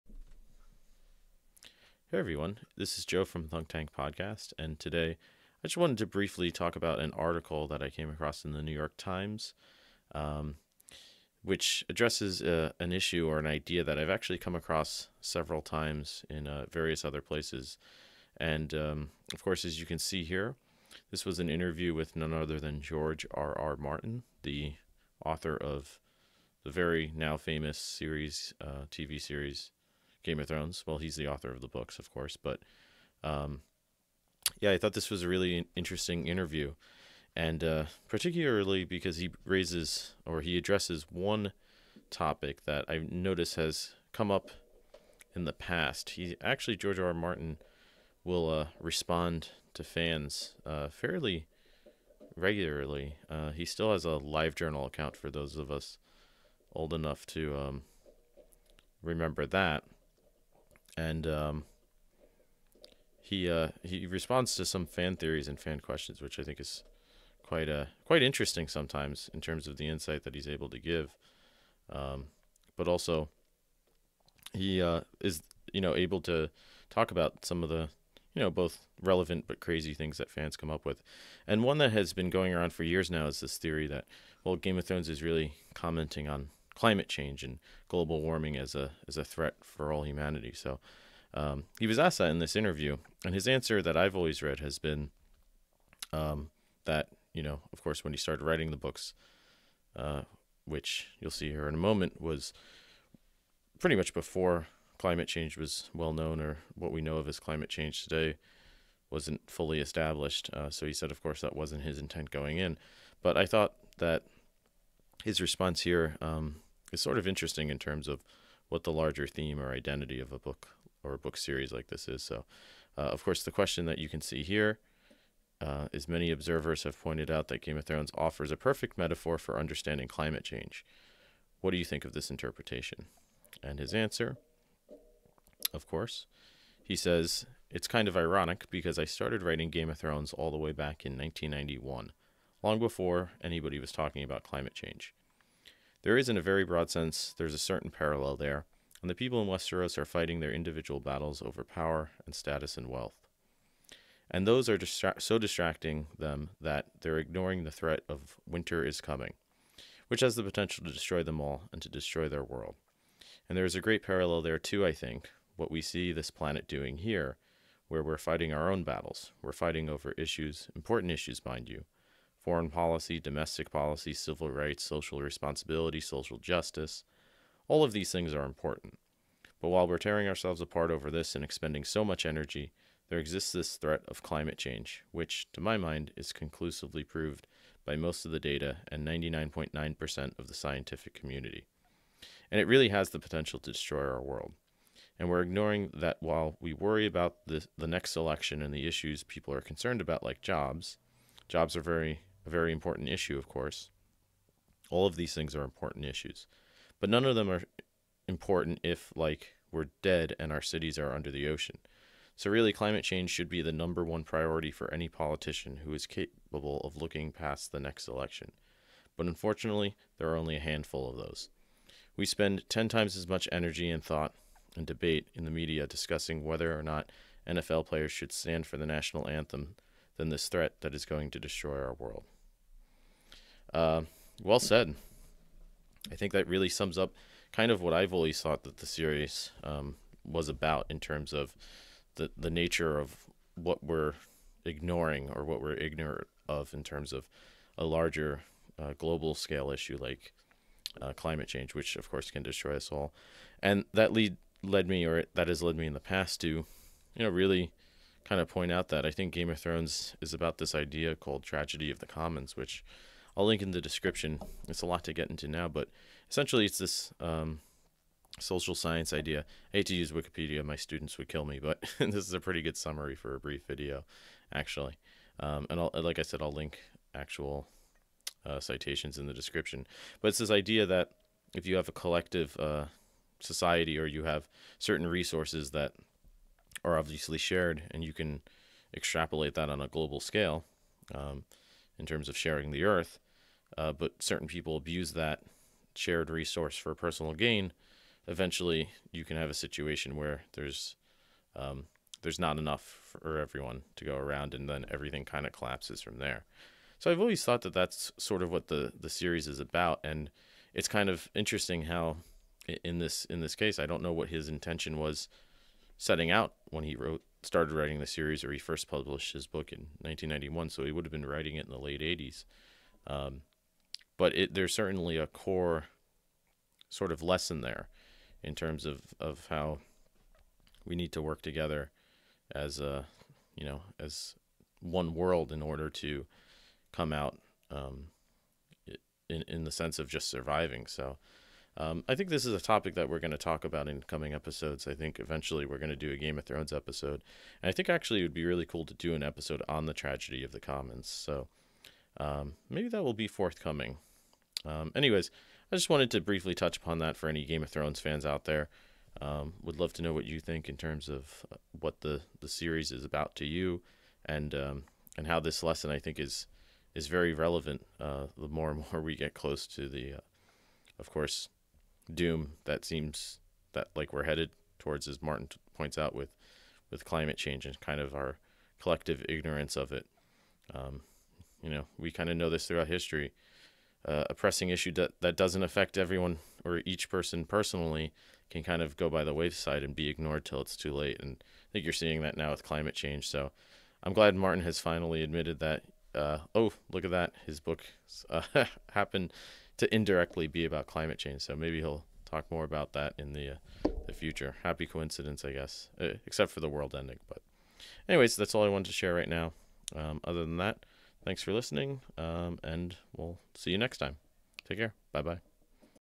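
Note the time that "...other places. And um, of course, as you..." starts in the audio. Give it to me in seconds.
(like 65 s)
17 s.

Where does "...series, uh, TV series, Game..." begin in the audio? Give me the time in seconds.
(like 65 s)
27 s.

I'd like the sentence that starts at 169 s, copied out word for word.
We're fighting over issues, important issues, mind you, foreign policy, domestic policy, civil rights, social responsibility, social justice.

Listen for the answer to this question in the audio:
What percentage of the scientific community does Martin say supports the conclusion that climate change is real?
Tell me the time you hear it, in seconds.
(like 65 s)
189 s.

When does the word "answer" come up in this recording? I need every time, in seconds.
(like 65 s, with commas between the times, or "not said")
93 s, 133 s.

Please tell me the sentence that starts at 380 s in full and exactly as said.
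Um, you know, we kind of know this throughout history.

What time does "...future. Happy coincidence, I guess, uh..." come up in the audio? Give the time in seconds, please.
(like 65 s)
404 s.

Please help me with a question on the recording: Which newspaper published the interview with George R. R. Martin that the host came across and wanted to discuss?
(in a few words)
New York Times.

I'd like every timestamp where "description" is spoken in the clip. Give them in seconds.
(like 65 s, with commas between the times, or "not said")
263 s, 279 s.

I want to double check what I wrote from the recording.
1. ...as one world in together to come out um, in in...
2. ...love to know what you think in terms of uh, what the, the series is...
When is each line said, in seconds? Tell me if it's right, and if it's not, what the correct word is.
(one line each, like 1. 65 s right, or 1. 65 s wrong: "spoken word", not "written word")
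1. 333 s wrong: "order", not "together"
2. 359 s right.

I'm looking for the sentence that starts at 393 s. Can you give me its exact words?
So I'm glad Martin has finally admitted that.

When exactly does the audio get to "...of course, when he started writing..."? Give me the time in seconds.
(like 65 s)
97 s.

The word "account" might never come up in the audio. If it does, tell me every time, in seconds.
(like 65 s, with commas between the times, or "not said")
54 s.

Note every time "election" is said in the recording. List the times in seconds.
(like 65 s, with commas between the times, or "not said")
198 s, 218 s.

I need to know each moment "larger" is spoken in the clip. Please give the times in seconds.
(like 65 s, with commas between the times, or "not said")
118 s, 247 s.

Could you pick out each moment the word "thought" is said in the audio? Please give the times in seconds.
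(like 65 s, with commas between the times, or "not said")
34 s, 113 s, 224 s, 238 s, 307 s.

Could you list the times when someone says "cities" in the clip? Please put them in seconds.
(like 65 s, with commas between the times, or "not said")
210 s.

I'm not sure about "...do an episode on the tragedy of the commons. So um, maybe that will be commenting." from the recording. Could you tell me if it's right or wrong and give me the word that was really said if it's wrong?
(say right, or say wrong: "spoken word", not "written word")
wrong: "forthcoming", not "commenting".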